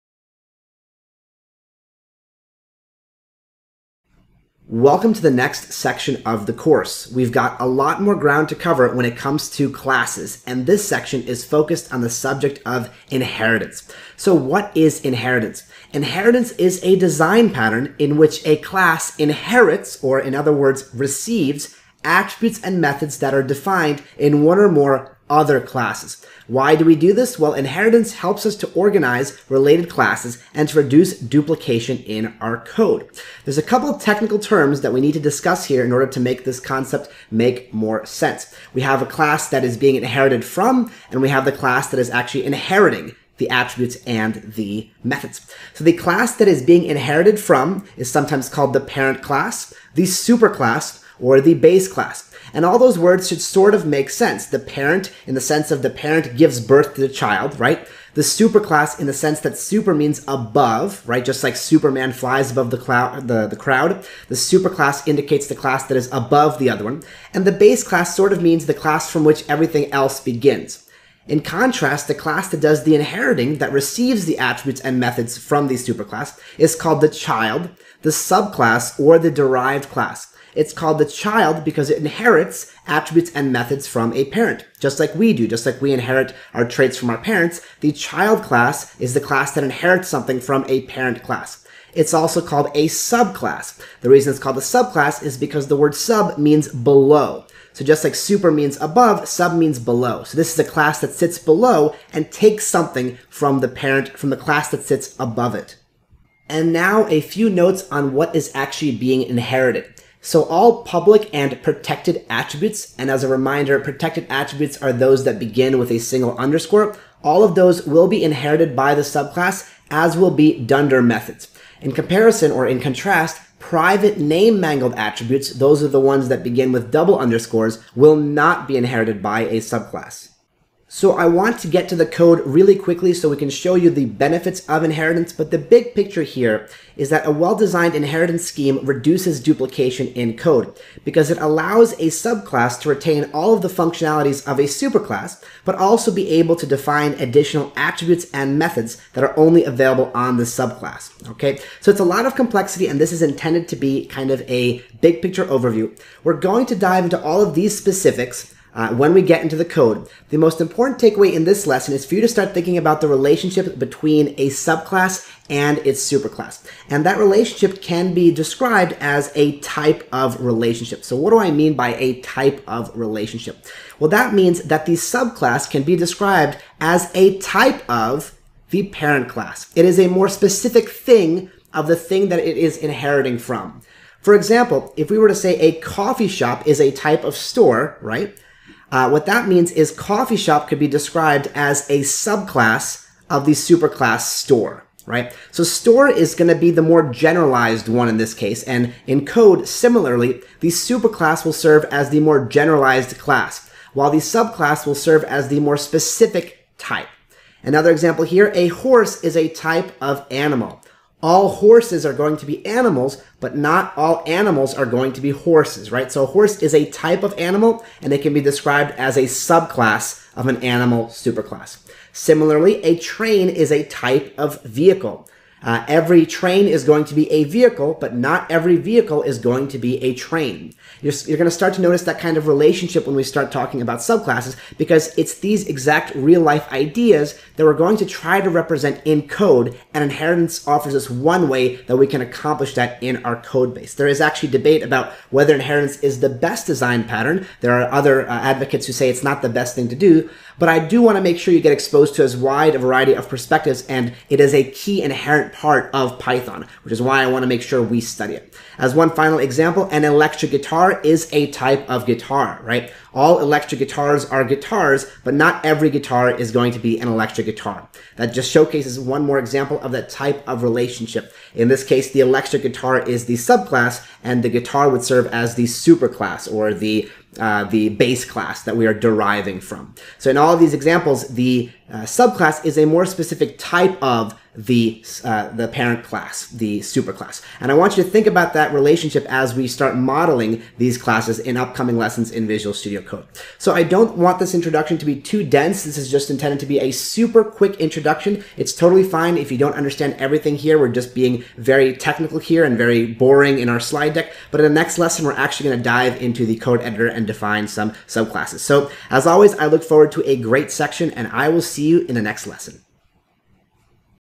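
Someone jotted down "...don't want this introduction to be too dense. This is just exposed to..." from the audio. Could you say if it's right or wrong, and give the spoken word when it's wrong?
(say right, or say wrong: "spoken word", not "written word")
wrong: "intended", not "exposed".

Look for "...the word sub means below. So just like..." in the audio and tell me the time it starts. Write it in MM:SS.
01:35.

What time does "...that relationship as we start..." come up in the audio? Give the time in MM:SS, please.
04:48.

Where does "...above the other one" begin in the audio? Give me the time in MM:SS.
01:06.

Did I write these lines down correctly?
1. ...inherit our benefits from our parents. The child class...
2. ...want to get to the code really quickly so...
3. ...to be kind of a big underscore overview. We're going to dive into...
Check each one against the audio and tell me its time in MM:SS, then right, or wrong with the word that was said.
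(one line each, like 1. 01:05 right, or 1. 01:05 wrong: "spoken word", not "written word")
1. 01:25 wrong: "traits", not "benefits"
2. 02:11 right
3. 02:33 wrong: "picture", not "underscore".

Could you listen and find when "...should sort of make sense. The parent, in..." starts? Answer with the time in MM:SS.
00:53.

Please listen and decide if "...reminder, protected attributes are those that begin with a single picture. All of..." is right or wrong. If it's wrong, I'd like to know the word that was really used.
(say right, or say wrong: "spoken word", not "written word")
wrong: "underscore", not "picture".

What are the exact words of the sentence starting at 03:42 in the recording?
Similarly, a train is a type of vehicle.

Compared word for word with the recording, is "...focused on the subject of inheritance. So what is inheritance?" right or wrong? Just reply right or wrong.
right.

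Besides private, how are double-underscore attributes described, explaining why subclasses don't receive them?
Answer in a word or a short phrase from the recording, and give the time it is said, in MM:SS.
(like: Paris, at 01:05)
name mangled, at 02:04.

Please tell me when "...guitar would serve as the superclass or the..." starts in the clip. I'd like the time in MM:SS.
04:34.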